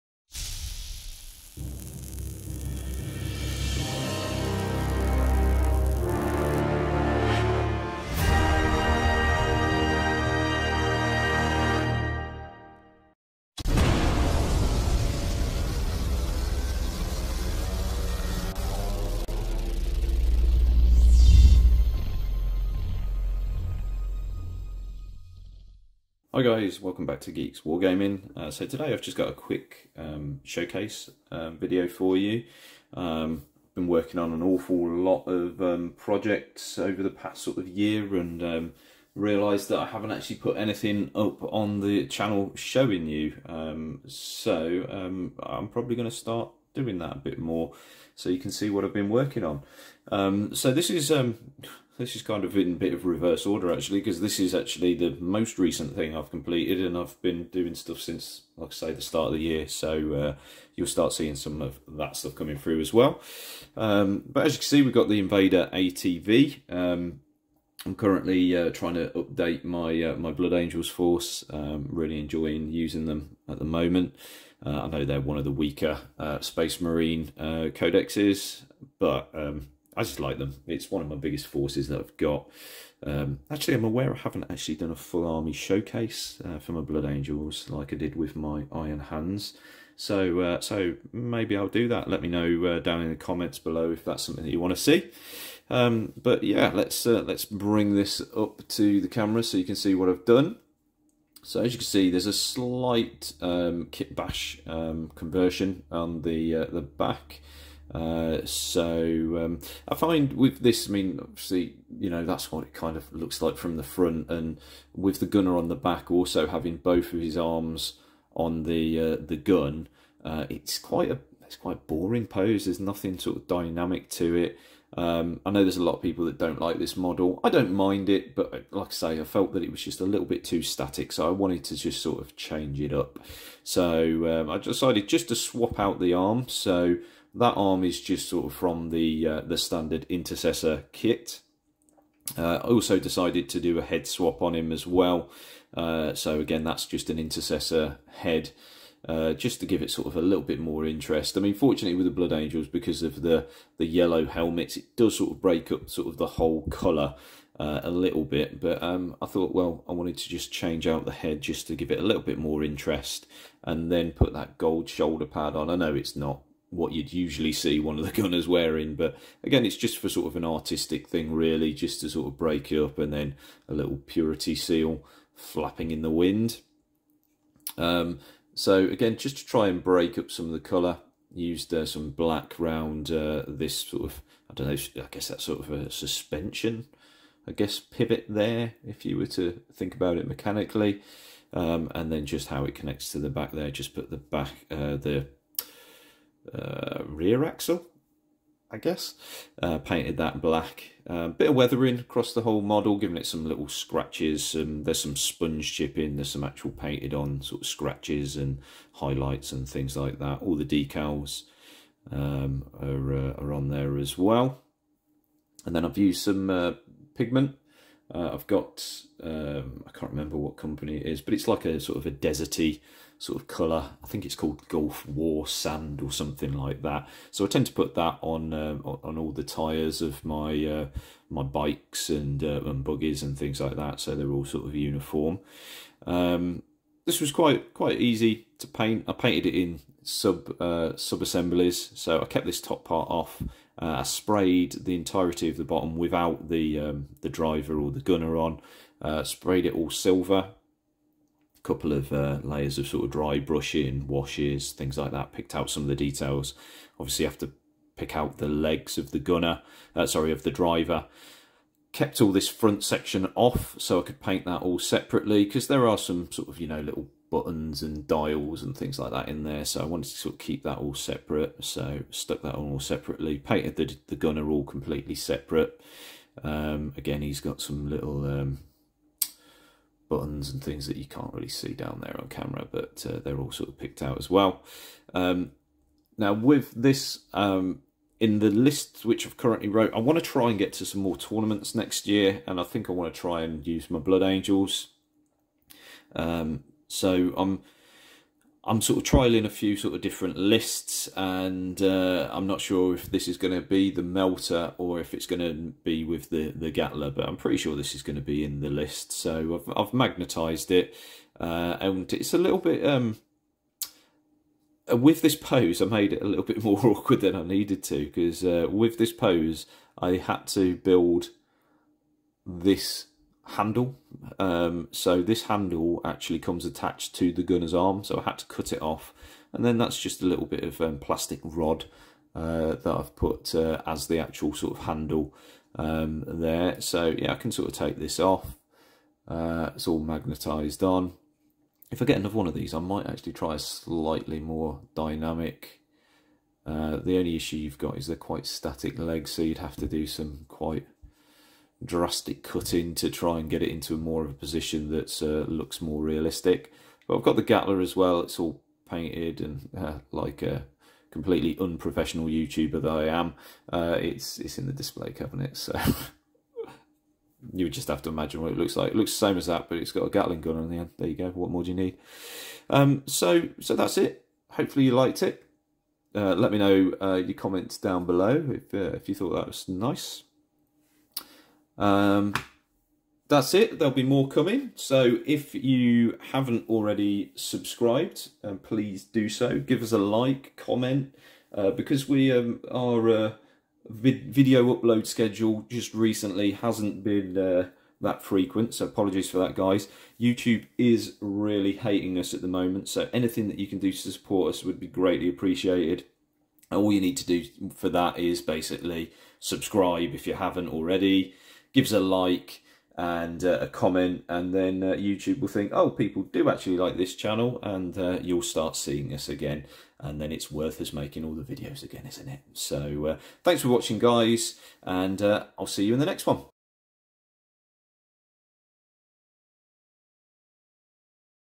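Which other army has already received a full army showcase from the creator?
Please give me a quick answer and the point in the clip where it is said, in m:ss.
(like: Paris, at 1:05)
Iron Hands, at 1:28.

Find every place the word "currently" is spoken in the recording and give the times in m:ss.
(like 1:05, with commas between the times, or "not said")
1:07, 4:49.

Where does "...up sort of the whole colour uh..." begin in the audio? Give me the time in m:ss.
2:35.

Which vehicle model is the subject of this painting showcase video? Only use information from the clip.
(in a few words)
Invader ATV.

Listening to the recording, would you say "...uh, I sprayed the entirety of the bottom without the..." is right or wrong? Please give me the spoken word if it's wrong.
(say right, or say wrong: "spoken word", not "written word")
right.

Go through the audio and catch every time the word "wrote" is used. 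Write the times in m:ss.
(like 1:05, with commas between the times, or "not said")
4:49.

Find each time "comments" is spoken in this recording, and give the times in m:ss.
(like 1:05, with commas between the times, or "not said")
1:33, 6:17, 6:30, 6:53.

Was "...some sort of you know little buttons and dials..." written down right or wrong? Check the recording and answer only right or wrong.
right.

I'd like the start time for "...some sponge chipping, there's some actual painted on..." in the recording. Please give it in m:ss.
3:25.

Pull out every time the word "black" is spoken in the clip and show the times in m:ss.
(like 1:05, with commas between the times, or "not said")
3:02, 3:20.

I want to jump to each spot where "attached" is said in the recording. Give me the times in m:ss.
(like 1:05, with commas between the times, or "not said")
5:26.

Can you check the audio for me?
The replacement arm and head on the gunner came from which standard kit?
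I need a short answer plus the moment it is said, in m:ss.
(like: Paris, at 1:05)
Intercessor kit, at 2:20.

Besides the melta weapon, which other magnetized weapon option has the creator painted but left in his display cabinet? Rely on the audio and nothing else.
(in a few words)
Gatling gun.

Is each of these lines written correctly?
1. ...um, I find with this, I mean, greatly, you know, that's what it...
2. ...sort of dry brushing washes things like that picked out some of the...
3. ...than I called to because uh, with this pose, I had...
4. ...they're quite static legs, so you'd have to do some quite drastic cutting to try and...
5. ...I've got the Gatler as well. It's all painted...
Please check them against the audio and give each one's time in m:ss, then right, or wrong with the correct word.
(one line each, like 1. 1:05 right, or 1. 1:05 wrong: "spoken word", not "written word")
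1. 1:49 wrong: "obviously", not "greatly"
2. 4:12 right
3. 5:17 wrong: "needed", not "called"
4. 5:48 right
5. 5:57 right.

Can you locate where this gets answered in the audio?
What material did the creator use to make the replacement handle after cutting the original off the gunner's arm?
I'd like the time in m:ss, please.
5:30.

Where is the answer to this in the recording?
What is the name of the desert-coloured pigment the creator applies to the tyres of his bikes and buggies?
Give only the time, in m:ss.
3:44.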